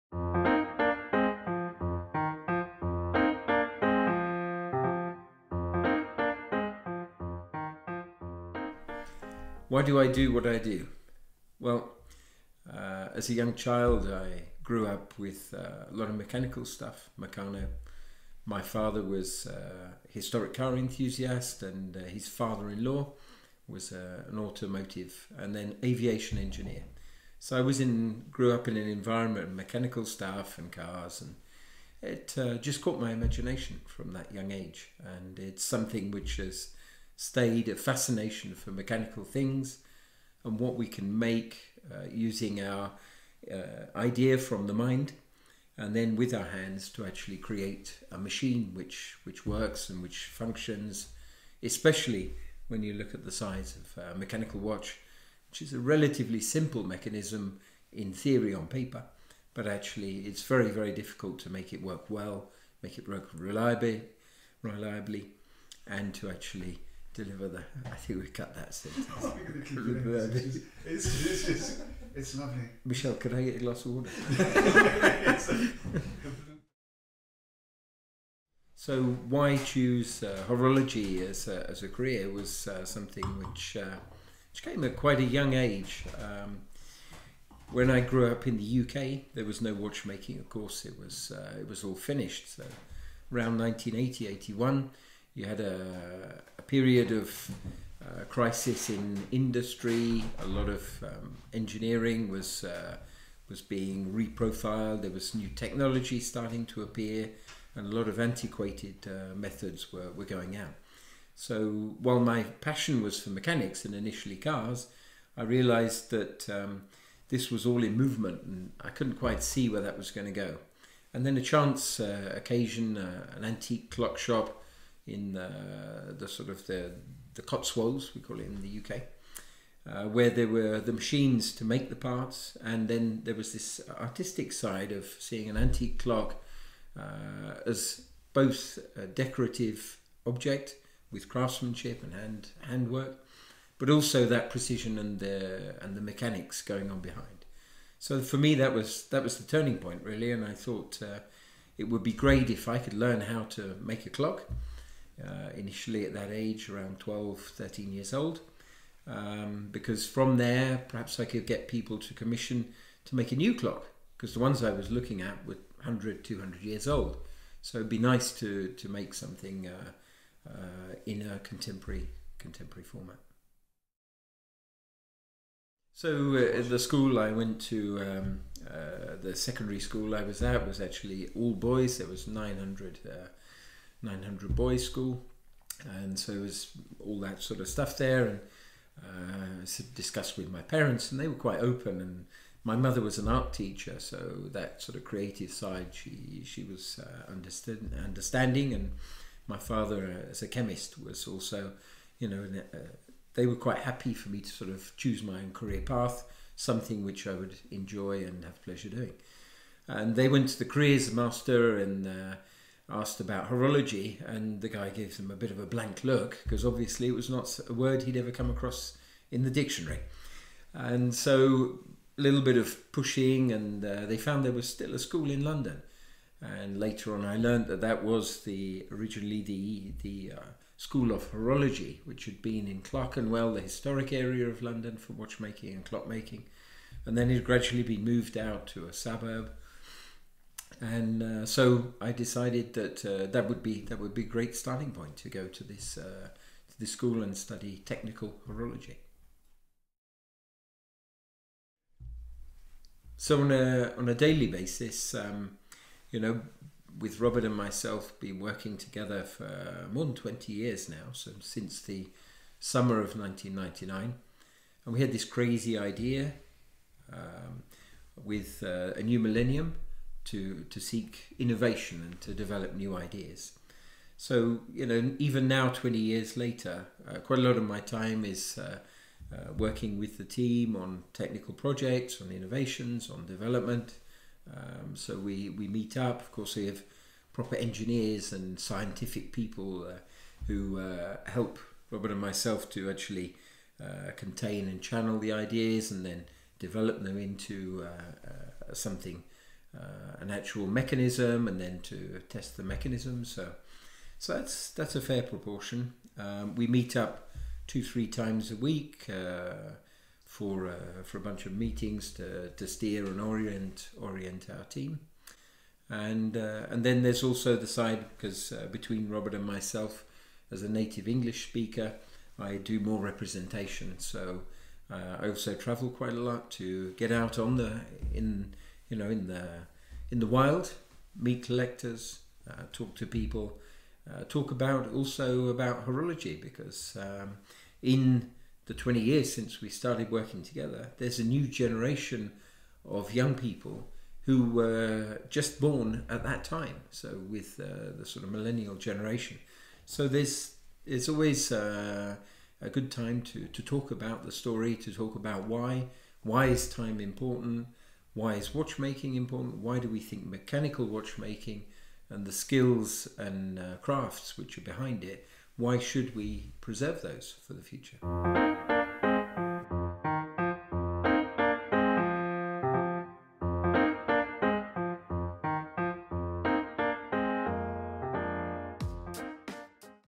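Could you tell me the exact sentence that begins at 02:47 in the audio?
So it'd be nice to, to make something uh, uh, in a contemporary, contemporary format.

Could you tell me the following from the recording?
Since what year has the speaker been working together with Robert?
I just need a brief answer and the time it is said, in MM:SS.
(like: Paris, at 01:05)
1999, at 04:23.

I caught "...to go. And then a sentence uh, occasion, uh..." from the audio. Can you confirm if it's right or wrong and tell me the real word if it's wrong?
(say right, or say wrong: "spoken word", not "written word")
wrong: "chance", not "sentence".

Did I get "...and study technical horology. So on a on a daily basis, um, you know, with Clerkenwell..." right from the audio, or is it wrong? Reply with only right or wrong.
wrong.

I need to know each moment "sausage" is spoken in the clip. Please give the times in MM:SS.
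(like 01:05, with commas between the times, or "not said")
not said.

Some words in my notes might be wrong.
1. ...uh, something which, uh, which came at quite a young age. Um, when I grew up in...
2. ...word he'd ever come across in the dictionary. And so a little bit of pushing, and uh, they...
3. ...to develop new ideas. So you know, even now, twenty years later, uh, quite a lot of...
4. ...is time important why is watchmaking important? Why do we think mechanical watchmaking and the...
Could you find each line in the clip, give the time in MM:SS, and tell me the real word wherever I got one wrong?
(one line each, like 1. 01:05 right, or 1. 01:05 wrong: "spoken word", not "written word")
1. 01:22 right
2. 03:37 right
3. 04:32 right
4. 05:56 right.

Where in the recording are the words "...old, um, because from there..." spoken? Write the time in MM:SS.
02:38.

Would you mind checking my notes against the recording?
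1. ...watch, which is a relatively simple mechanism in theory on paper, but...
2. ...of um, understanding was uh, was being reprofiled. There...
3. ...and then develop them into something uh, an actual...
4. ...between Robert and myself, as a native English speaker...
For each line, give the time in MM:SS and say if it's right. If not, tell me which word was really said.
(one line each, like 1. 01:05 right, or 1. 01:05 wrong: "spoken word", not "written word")
1. 00:54 right
2. 01:40 wrong: "engineering", not "understanding"
3. 04:55 right
4. 05:18 right.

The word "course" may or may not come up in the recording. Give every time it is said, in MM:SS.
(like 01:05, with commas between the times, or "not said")
01:30, 04:46.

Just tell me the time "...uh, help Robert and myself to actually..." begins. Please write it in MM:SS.
04:50.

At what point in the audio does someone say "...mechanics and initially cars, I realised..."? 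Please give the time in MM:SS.
01:53.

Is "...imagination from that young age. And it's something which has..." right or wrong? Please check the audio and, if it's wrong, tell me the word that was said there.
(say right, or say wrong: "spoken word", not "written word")
right.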